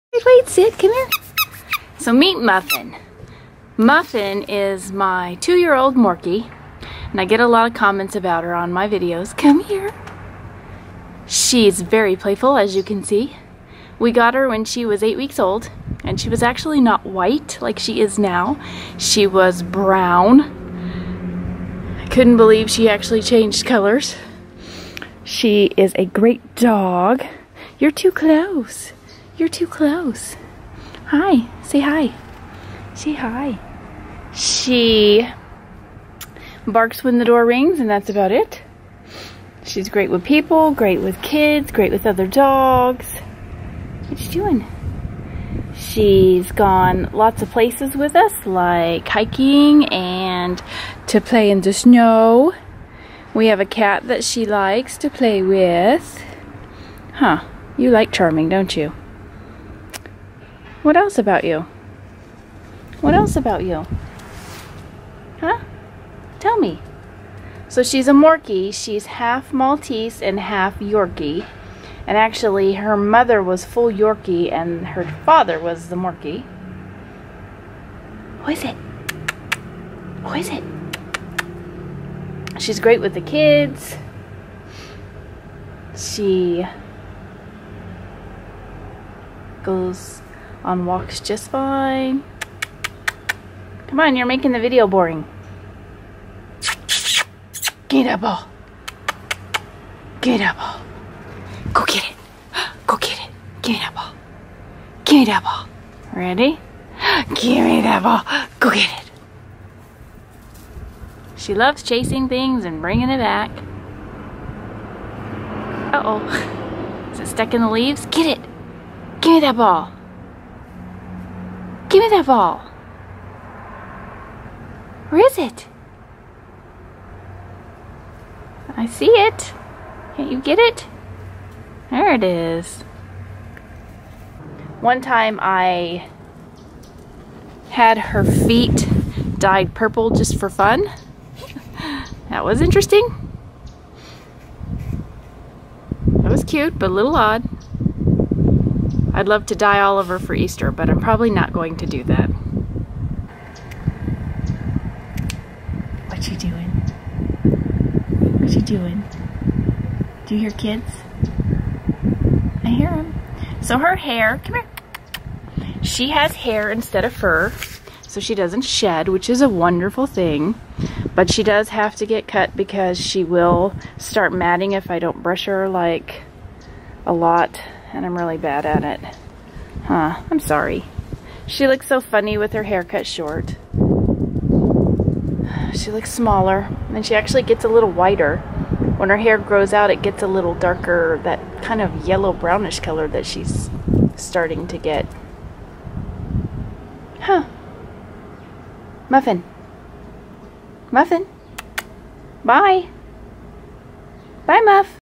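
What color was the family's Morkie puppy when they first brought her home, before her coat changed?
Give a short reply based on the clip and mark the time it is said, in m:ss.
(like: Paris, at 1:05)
Brown, at 0:18.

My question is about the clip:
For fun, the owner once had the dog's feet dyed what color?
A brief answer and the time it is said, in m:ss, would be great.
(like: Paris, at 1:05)
Purple, at 2:19.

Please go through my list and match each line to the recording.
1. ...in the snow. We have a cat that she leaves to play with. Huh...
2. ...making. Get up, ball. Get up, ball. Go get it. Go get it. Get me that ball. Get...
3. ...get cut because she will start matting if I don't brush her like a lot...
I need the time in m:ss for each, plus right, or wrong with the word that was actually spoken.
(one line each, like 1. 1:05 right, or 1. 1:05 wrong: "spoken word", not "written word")
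1. 0:51 wrong: "likes", not "leaves"
2. 1:34 wrong: "boring", not "making"
3. 2:52 right.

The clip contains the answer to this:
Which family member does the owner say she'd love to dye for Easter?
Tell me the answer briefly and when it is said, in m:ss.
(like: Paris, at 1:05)
Oliver, at 2:29.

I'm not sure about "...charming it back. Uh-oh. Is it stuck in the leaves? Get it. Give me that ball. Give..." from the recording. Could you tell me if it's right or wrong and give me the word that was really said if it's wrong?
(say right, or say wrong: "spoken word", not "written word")
wrong: "bringing", not "charming".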